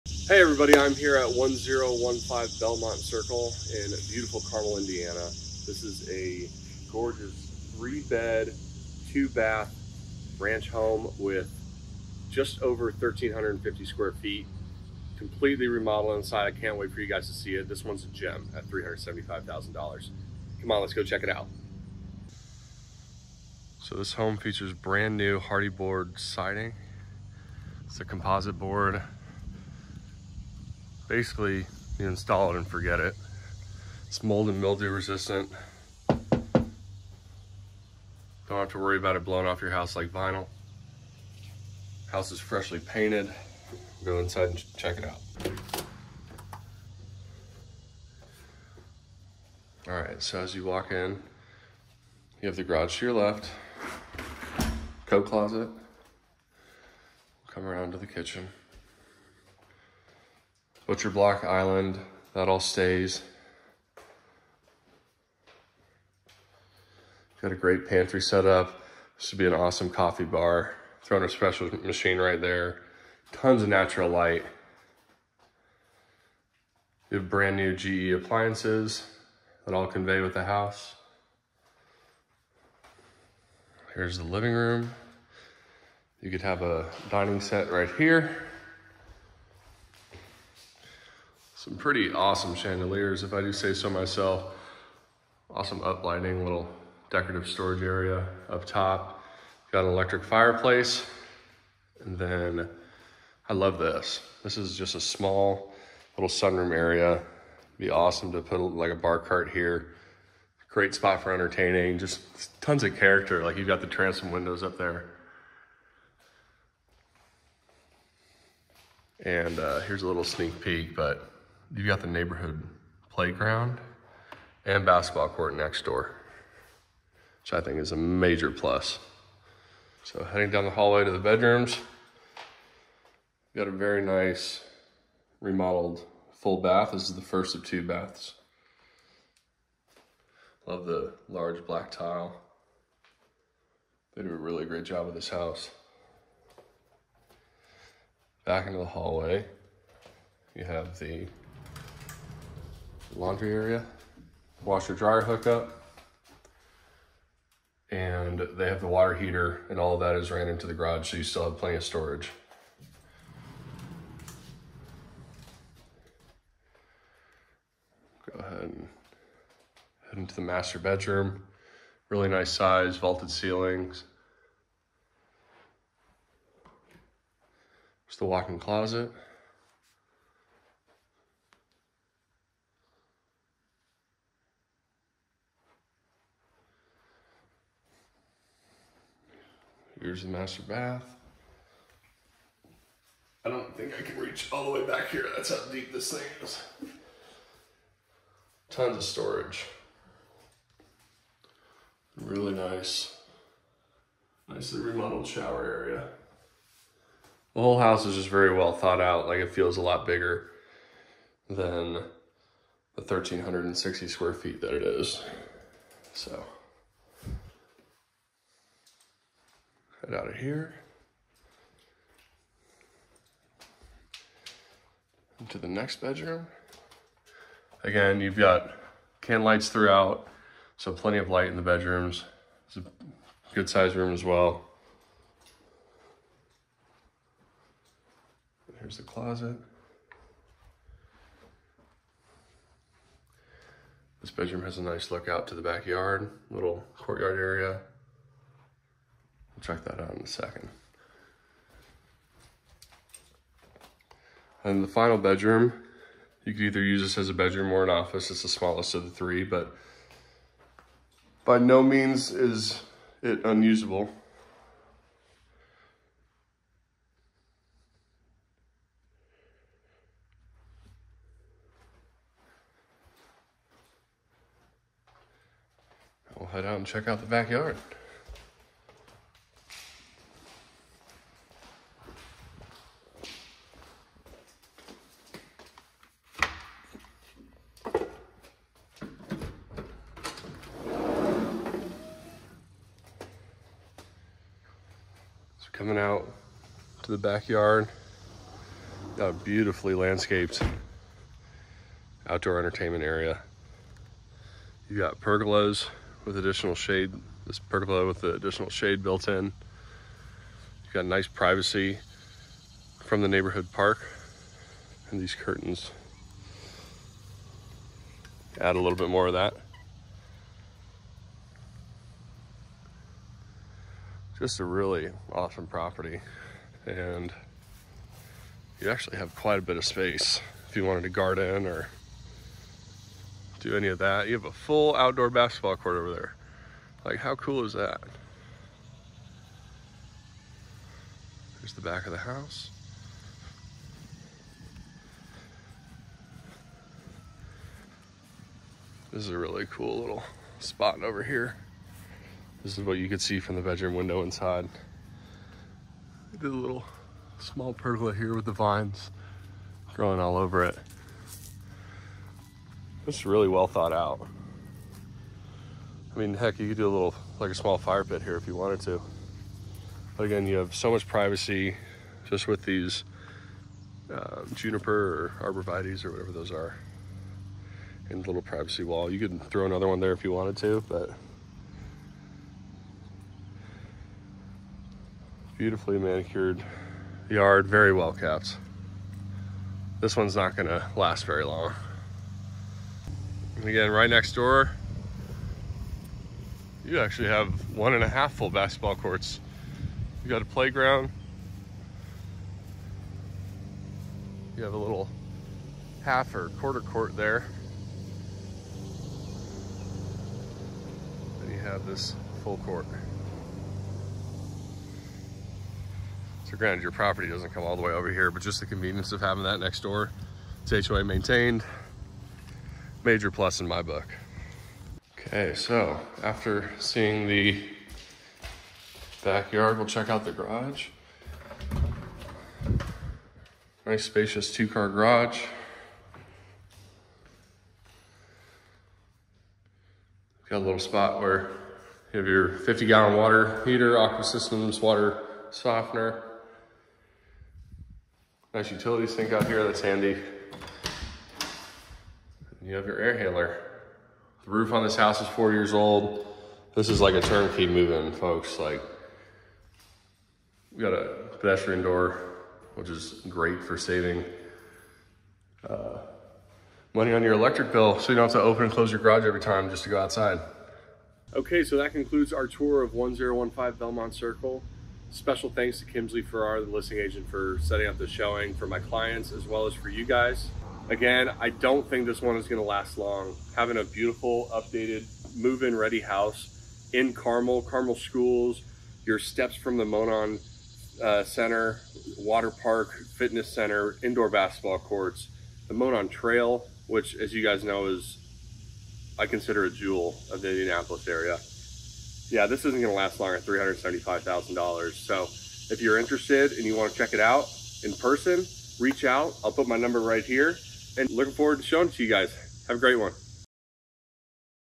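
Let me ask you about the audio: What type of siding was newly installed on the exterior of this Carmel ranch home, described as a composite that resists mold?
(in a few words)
Hardie board.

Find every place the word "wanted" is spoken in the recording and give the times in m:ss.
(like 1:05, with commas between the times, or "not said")
5:30, 6:08, 6:20.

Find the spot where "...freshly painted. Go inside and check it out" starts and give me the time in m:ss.
0:42.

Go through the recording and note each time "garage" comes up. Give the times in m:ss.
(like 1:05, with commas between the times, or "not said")
0:52, 2:40, 7:10, 7:14, 7:48.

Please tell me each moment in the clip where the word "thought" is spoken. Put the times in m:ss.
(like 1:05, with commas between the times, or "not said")
3:28, 6:03.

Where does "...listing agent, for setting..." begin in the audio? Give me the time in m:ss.
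7:56.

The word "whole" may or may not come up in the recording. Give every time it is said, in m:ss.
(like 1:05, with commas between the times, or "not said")
3:27.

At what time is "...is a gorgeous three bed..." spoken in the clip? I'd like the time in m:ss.
0:05.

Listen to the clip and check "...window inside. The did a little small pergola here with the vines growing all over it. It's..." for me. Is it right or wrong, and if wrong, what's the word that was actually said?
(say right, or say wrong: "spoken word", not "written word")
right.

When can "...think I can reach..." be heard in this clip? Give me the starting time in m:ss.
3:13.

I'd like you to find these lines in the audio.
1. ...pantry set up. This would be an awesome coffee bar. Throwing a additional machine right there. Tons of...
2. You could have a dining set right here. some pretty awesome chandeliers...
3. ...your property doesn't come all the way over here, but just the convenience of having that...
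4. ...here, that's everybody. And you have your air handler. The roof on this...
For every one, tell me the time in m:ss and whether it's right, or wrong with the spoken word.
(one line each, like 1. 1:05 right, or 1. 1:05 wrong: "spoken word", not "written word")
1. 1:07 wrong: "special", not "additional"
2. 1:26 right
3. 6:56 right
4. 7:29 wrong: "handy", not "everybody".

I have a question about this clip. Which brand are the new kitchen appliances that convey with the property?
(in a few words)
GE.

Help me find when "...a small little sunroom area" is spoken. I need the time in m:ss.
1:44.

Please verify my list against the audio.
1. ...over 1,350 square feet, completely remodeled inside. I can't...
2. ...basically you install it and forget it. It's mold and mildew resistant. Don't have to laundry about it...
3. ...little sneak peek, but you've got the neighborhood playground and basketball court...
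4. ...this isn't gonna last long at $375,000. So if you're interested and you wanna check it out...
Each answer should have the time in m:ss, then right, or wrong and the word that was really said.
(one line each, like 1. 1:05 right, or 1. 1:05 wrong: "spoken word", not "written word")
1. 0:12 right
2. 0:31 wrong: "worry", not "laundry"
3. 2:00 right
4. 8:22 right.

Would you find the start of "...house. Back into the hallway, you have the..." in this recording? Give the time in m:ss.
2:25.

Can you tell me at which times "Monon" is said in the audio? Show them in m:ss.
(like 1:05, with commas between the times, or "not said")
8:09, 8:15.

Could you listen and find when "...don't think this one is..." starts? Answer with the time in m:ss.
8:01.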